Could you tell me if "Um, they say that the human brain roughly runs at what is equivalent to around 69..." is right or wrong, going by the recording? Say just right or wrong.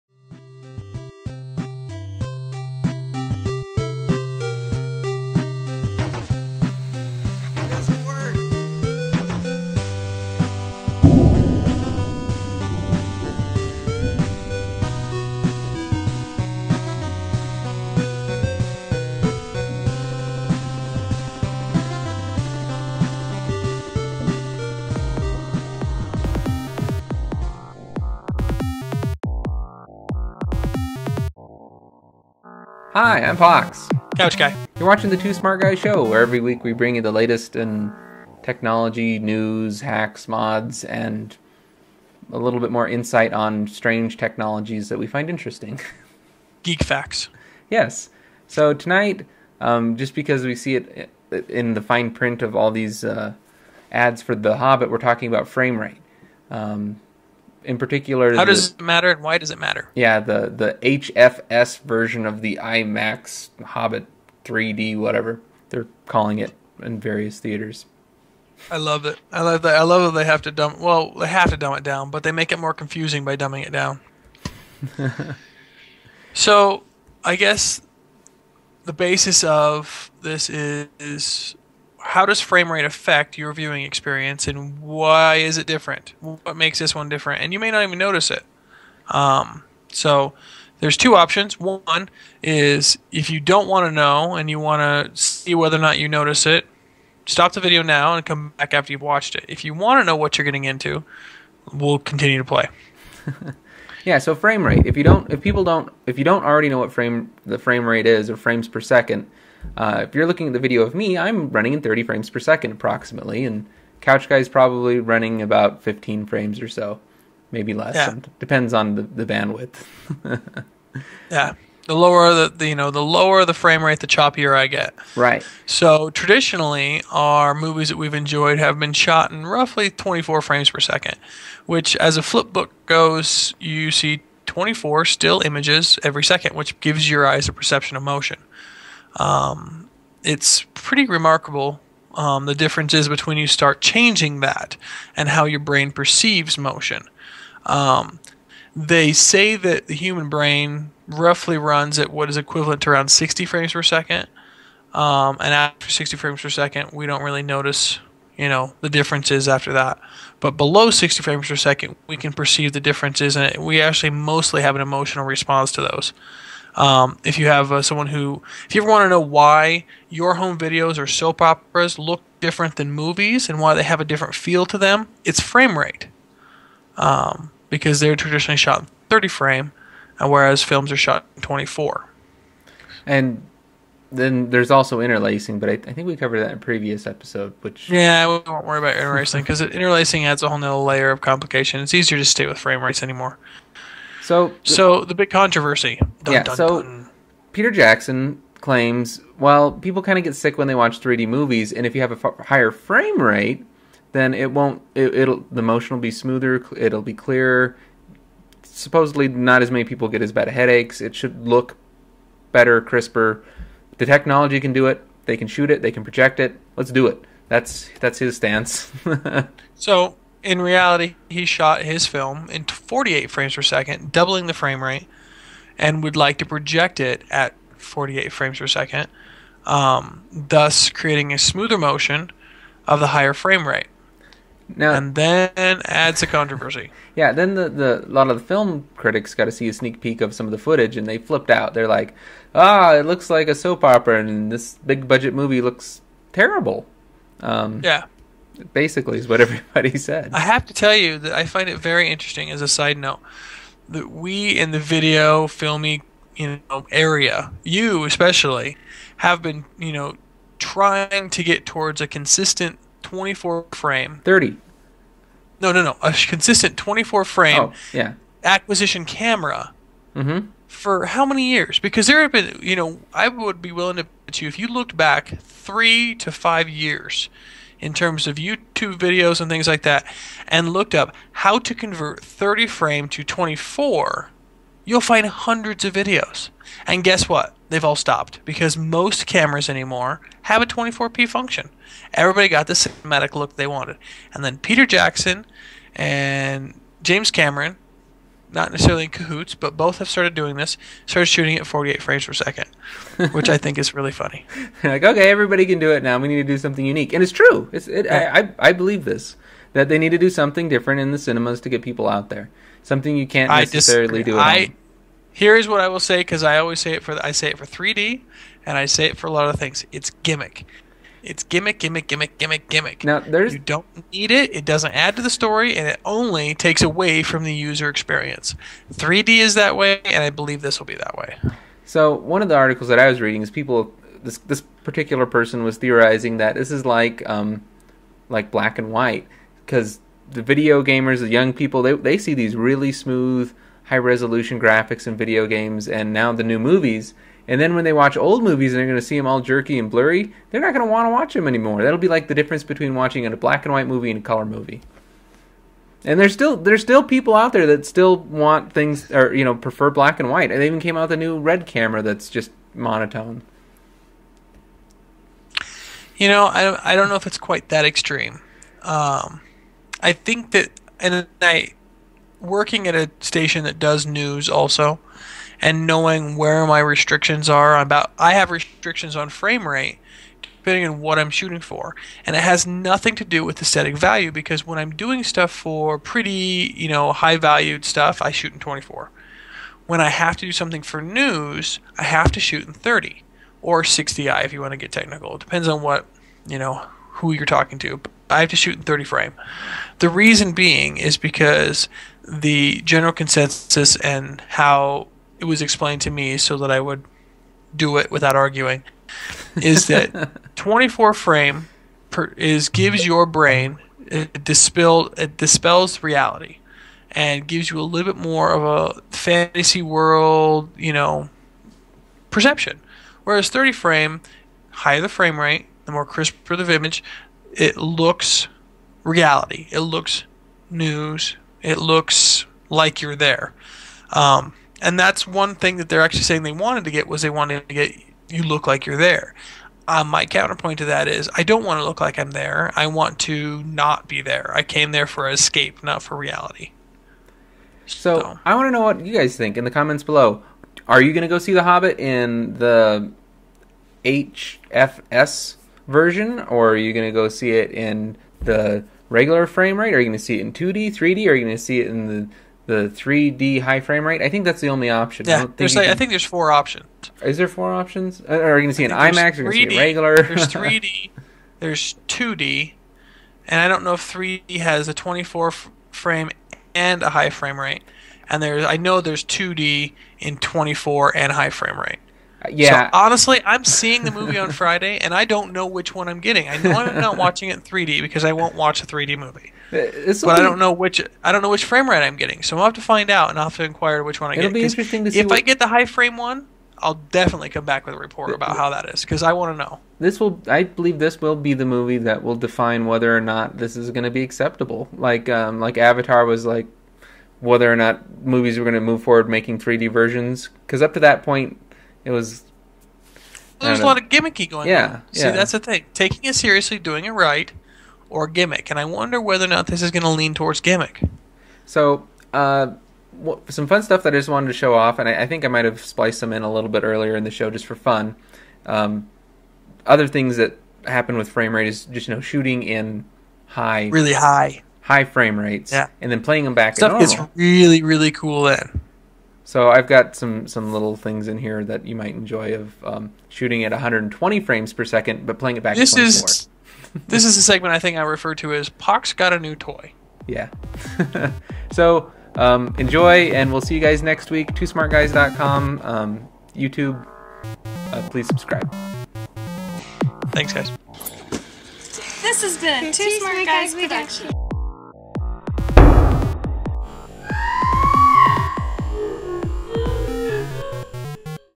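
wrong.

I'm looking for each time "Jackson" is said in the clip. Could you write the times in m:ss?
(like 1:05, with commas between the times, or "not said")
3:17, 4:54.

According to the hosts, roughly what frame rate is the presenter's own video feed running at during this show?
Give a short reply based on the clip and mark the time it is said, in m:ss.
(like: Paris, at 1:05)
30 frames per second, at 1:51.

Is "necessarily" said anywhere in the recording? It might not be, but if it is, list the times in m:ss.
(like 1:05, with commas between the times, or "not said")
4:58, 5:13.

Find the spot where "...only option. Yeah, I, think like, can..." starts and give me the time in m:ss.
7:44.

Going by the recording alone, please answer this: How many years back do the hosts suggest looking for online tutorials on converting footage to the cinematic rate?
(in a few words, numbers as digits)
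three to five years.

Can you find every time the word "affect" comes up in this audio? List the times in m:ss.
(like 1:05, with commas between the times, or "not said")
1:22.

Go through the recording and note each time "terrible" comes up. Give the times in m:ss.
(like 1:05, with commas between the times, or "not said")
4:06.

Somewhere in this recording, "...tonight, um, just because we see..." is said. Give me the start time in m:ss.
0:48.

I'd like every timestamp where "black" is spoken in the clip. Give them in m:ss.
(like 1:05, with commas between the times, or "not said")
5:38, 5:53, 5:59.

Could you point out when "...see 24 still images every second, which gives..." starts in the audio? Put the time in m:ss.
2:13.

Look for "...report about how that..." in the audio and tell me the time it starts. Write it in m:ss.
8:17.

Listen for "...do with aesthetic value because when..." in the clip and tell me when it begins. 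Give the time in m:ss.
6:23.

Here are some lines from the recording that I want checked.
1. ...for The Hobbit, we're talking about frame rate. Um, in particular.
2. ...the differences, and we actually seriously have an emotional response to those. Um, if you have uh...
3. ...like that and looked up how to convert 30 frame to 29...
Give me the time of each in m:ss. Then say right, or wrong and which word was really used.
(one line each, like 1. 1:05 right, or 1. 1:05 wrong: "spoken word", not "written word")
1. 0:54 right
2. 2:42 wrong: "mostly", not "seriously"
3. 4:39 wrong: "24", not "29".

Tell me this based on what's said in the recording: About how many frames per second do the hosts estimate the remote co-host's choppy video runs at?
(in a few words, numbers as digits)
15.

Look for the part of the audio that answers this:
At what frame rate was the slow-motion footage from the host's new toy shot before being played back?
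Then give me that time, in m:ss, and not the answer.
9:03.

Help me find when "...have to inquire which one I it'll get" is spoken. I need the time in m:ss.
8:13.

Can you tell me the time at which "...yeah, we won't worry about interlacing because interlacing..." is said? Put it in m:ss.
3:07.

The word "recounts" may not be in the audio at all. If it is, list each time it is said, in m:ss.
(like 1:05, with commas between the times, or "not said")
not said.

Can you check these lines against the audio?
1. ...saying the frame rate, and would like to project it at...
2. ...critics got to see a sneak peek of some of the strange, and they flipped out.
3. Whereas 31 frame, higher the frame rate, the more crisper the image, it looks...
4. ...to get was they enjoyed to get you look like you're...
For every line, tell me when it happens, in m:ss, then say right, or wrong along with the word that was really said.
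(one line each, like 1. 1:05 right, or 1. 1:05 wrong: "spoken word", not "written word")
1. 3:44 wrong: "doubling", not "saying"
2. 3:58 wrong: "footage", not "strange"
3. 7:03 wrong: "30", not "31"
4. 7:16 wrong: "wanted", not "enjoyed".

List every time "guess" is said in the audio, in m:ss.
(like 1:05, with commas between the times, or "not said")
1:17, 4:47.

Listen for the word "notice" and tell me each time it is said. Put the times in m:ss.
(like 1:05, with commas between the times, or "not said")
1:27, 1:36, 2:37.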